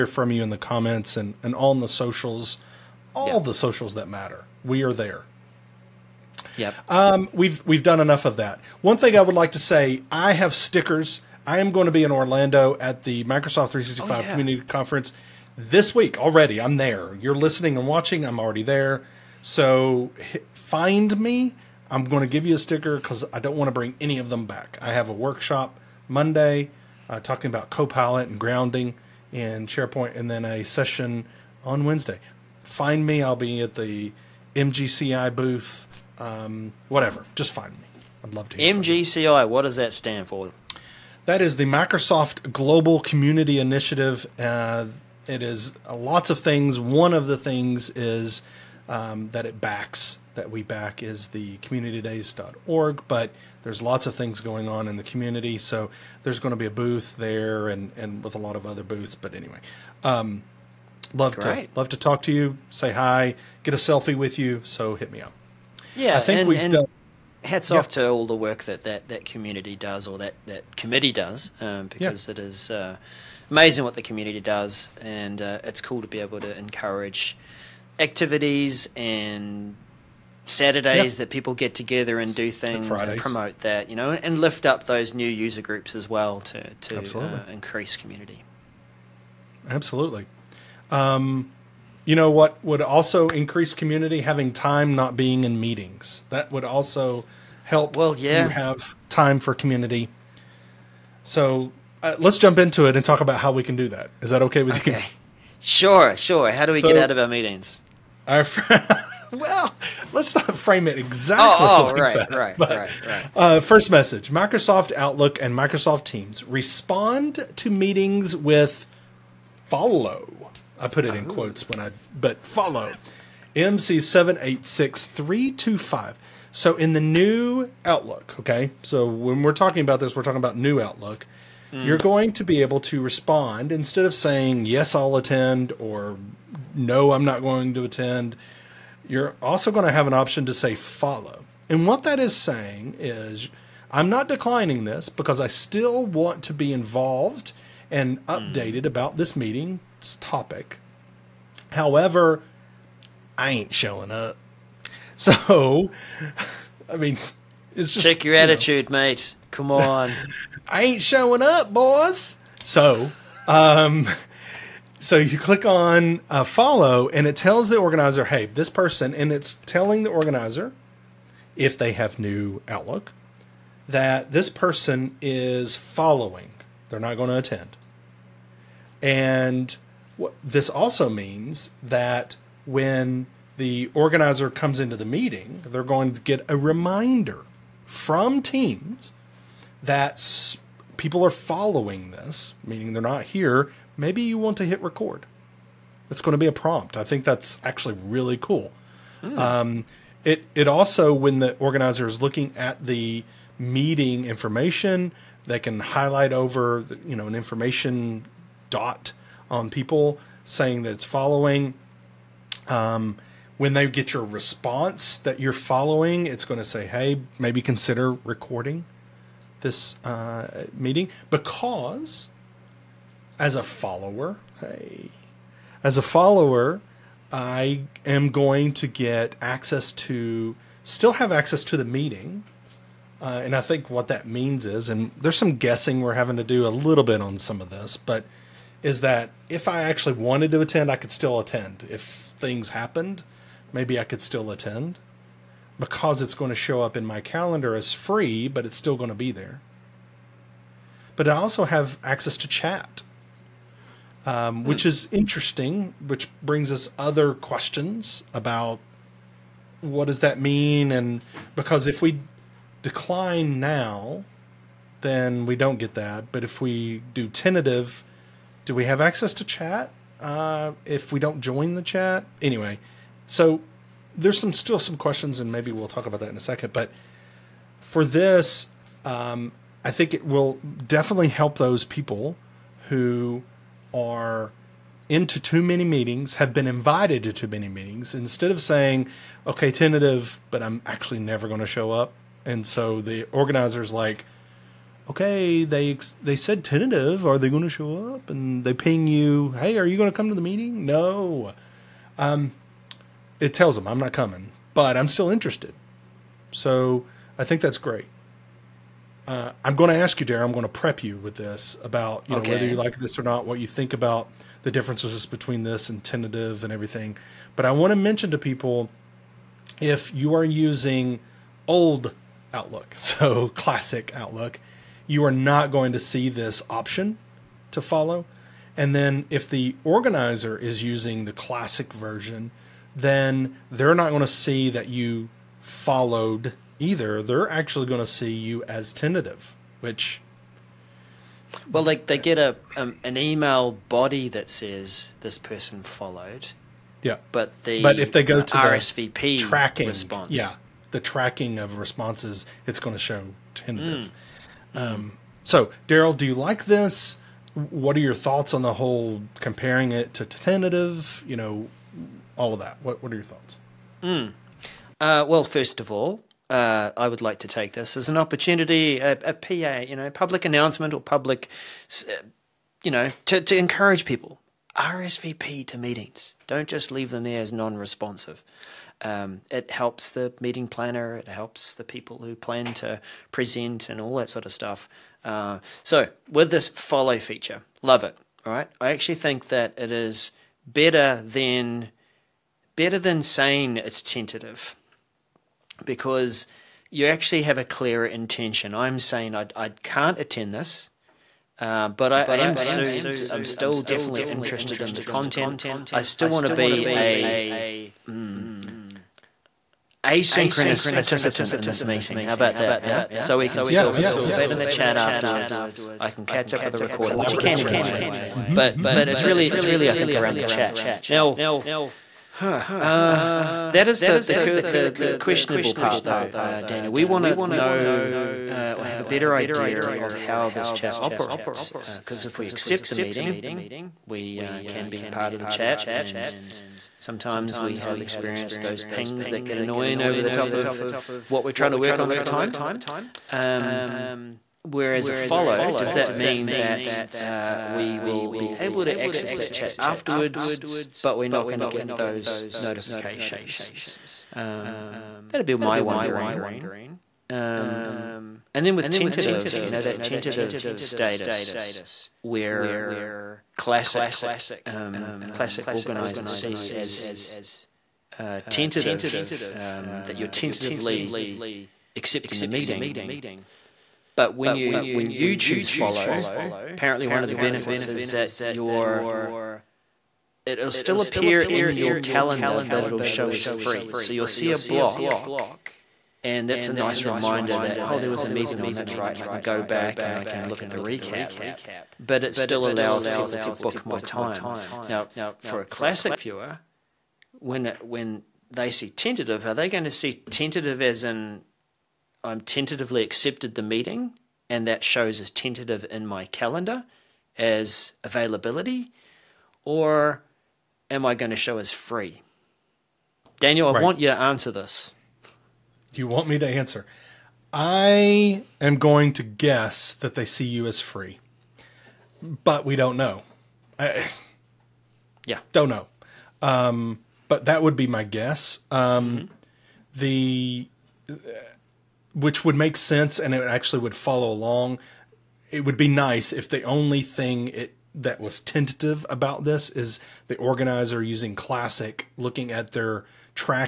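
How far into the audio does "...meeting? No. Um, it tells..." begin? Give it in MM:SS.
05:00.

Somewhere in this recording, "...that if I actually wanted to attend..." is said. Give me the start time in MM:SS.
03:59.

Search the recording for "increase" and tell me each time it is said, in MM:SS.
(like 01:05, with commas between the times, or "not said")
01:27, 01:33.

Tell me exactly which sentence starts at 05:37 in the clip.
They're actually going to see you as tentative, which.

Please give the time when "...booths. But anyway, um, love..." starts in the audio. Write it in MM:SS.
00:58.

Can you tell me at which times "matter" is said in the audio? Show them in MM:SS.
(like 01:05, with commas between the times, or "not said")
00:04.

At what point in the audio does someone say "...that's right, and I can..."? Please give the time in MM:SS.
08:08.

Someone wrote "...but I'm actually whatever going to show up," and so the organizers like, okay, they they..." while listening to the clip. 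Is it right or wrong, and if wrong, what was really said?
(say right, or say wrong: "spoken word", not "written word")
wrong: "never", not "whatever".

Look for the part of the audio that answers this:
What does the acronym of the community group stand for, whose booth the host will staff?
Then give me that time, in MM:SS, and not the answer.
00:41.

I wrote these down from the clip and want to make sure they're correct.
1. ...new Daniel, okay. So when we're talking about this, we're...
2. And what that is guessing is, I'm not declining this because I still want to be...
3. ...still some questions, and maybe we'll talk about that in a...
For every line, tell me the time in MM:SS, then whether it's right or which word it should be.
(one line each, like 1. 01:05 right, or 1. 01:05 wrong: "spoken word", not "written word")
1. 02:07 wrong: "Outlook", not "Daniel"
2. 02:21 wrong: "saying", not "guessing"
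3. 04:34 right.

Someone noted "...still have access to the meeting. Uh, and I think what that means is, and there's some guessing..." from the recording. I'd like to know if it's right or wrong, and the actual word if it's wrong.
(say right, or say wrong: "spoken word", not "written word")
right.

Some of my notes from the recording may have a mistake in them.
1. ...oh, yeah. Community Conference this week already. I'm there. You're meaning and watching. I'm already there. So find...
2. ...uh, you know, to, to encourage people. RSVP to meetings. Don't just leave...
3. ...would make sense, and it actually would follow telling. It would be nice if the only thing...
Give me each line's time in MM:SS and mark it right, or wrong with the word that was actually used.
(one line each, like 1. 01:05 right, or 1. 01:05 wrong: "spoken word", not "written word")
1. 00:14 wrong: "listening", not "meaning"
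2. 06:12 right
3. 08:52 wrong: "along", not "telling".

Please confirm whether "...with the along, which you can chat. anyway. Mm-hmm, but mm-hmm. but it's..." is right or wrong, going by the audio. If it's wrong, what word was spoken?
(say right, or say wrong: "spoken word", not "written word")
wrong: "recording", not "along".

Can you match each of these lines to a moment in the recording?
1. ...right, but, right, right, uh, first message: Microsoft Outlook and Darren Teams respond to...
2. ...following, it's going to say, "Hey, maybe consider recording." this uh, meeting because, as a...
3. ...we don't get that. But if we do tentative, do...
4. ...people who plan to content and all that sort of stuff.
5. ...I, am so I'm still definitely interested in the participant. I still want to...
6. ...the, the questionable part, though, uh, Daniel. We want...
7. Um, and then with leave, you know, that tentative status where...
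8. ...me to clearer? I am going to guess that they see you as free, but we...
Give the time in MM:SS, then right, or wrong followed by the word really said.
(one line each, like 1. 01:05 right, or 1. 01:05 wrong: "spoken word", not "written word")
1. 01:52 wrong: "Microsoft", not "Darren"
2. 03:35 right
3. 04:25 right
4. 06:21 wrong: "present", not "content"
5. 06:42 wrong: "content", not "participant"
6. 07:04 right
7. 07:37 wrong: "tentative", not "leave"
8. 08:36 wrong: "answer", not "clearer".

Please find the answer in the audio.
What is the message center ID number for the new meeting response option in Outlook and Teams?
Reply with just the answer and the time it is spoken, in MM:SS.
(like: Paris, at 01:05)
MC786325, at 02:03.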